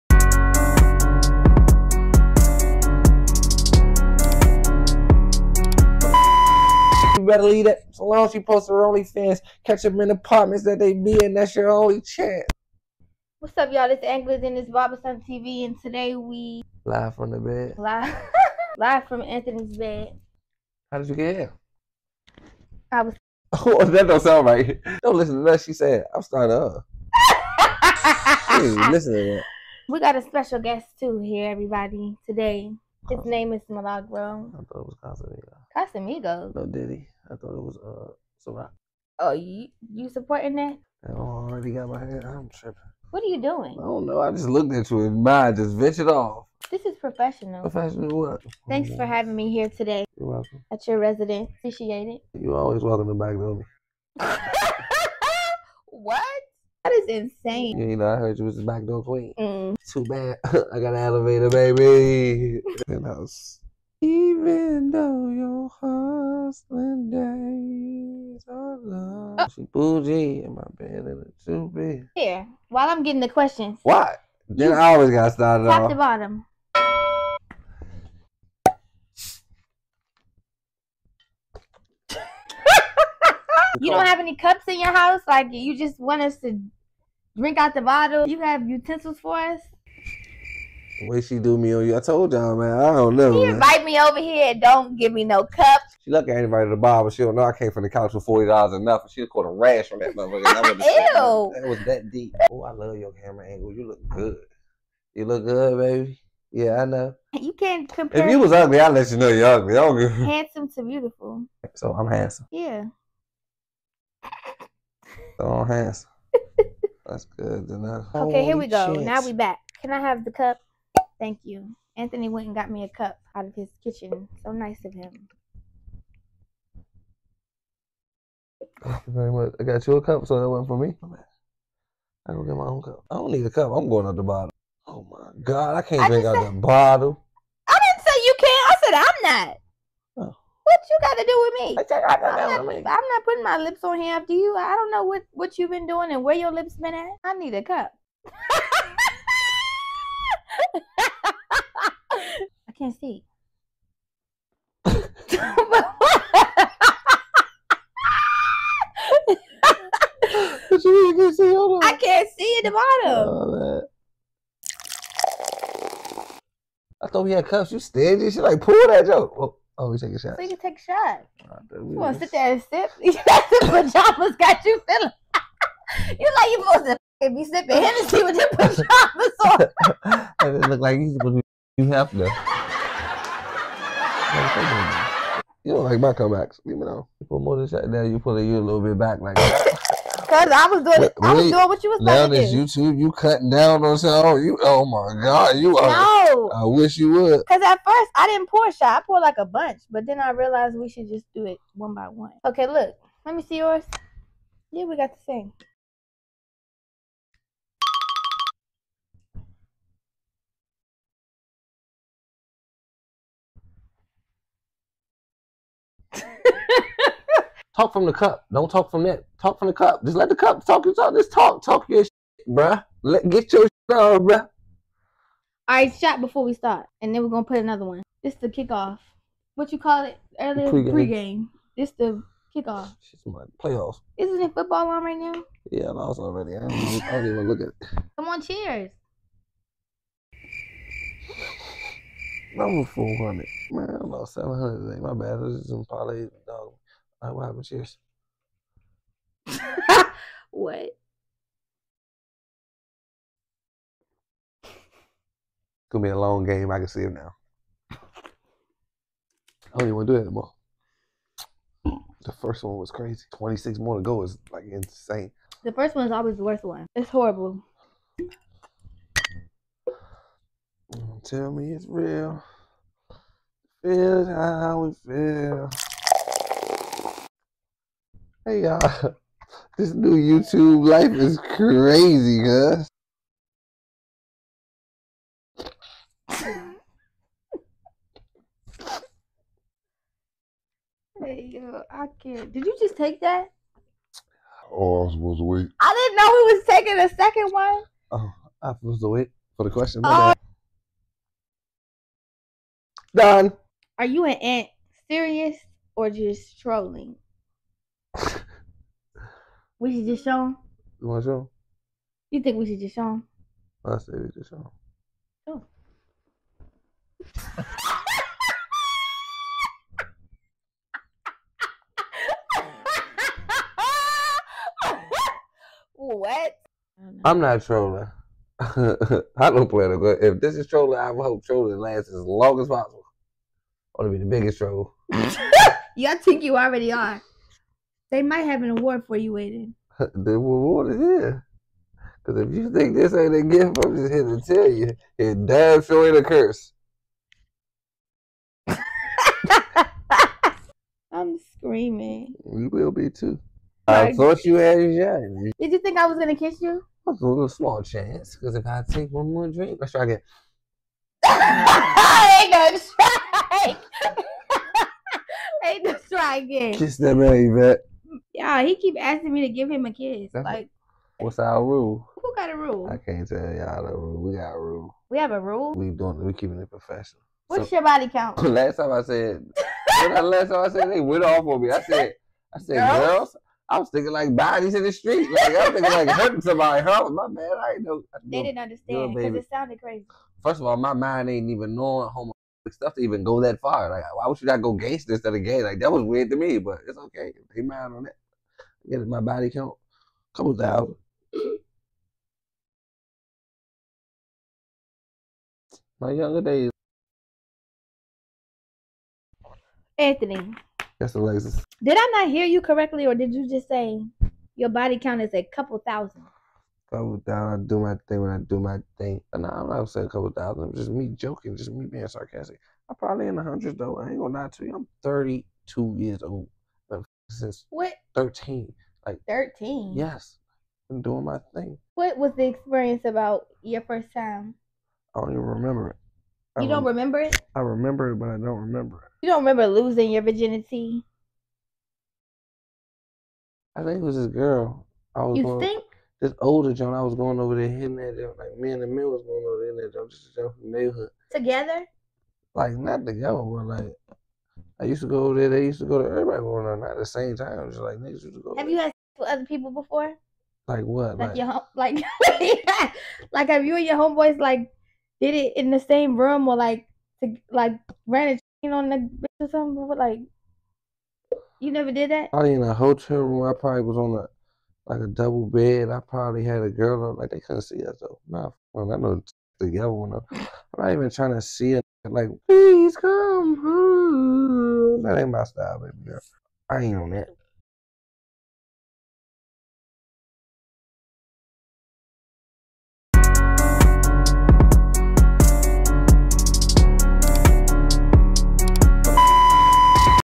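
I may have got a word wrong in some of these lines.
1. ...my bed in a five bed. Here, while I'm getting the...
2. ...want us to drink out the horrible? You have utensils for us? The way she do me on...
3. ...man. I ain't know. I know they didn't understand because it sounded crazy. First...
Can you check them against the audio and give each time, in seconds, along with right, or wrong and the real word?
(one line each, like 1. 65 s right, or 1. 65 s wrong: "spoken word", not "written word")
1. 70 s wrong: "two", not "five"
2. 85 s wrong: "bottle", not "horrible"
3. 387 s right.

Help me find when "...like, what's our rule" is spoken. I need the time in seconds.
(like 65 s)
370 s.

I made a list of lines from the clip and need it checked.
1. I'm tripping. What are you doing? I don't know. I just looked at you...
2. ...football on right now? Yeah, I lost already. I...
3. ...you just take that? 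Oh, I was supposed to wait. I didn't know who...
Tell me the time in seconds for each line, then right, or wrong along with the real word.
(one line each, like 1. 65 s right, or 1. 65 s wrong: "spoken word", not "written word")
1. 42 s right
2. 234 s right
3. 292 s right.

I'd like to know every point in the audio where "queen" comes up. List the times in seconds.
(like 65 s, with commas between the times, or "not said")
59 s.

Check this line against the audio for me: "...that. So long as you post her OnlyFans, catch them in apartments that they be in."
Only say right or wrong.
right.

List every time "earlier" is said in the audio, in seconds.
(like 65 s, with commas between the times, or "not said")
230 s.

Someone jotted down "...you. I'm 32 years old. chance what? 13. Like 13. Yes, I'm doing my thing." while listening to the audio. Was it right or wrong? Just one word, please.
wrong.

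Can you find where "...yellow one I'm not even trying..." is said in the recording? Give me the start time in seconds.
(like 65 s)
479 s.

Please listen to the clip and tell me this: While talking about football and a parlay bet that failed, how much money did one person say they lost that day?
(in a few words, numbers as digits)
700.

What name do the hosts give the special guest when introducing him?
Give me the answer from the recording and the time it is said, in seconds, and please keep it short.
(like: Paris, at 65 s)
Milagro, at 33 s.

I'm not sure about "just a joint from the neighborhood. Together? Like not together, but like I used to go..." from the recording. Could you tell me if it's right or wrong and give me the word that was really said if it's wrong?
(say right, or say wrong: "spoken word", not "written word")
right.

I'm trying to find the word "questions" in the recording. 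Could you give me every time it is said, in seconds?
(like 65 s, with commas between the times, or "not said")
73 s, 299 s.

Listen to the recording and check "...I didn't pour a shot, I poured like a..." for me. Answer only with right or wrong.
right.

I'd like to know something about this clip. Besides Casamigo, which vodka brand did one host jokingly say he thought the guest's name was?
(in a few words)
Ciroc.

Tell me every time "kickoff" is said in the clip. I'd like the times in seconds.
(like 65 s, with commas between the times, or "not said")
228 s, 232 s.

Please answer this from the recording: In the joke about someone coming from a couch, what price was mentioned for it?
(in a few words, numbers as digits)
$40.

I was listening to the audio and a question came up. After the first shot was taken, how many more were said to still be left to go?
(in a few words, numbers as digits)
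26.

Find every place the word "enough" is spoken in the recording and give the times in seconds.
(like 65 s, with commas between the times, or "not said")
98 s, 117 s.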